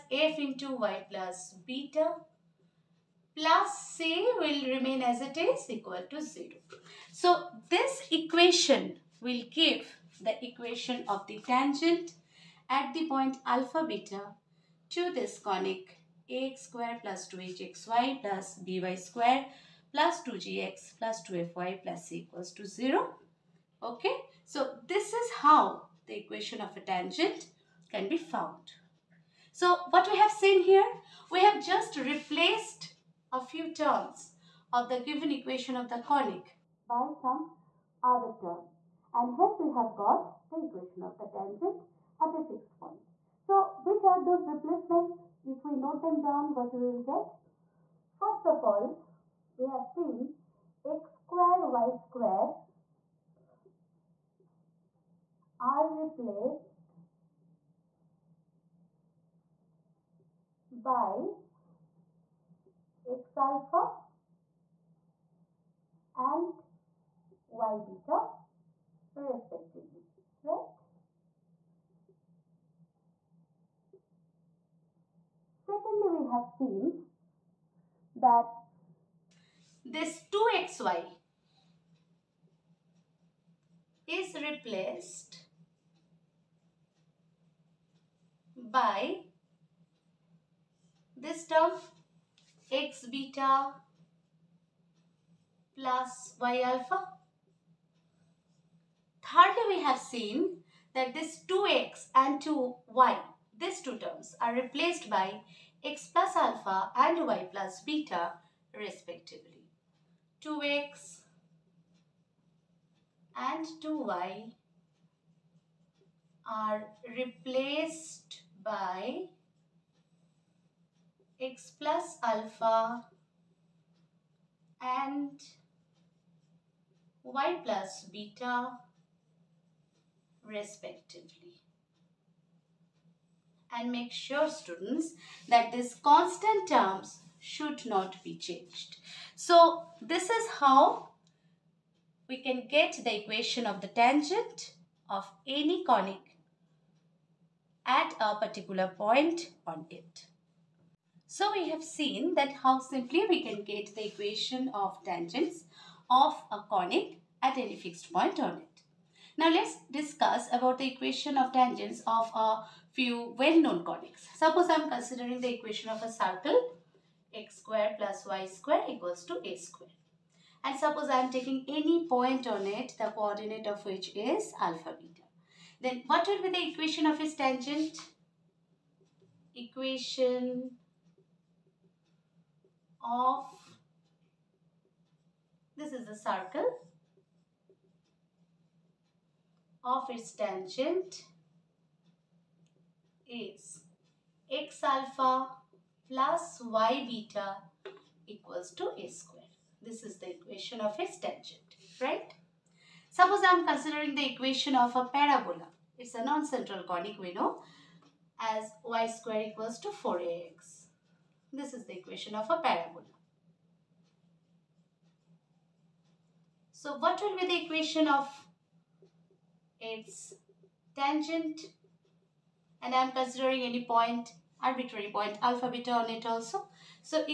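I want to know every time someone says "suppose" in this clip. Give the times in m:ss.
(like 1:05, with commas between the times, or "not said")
2:44, 2:50, 3:23.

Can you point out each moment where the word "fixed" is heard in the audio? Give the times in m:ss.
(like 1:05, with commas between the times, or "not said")
0:42, 2:37.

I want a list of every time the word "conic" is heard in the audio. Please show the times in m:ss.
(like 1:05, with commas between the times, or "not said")
0:15, 0:36, 2:25, 2:36, 2:43, 3:26.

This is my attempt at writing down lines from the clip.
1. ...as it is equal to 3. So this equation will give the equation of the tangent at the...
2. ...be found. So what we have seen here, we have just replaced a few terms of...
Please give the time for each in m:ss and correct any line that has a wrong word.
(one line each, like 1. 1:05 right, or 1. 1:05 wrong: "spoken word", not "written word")
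1. 0:05 wrong: "0", not "3"
2. 0:28 right.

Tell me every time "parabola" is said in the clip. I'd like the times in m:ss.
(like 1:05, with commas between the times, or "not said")
3:25, 3:32.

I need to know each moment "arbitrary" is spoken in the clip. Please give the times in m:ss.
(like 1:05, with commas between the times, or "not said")
3:44.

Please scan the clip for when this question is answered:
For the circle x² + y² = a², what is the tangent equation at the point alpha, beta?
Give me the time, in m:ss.
3:14.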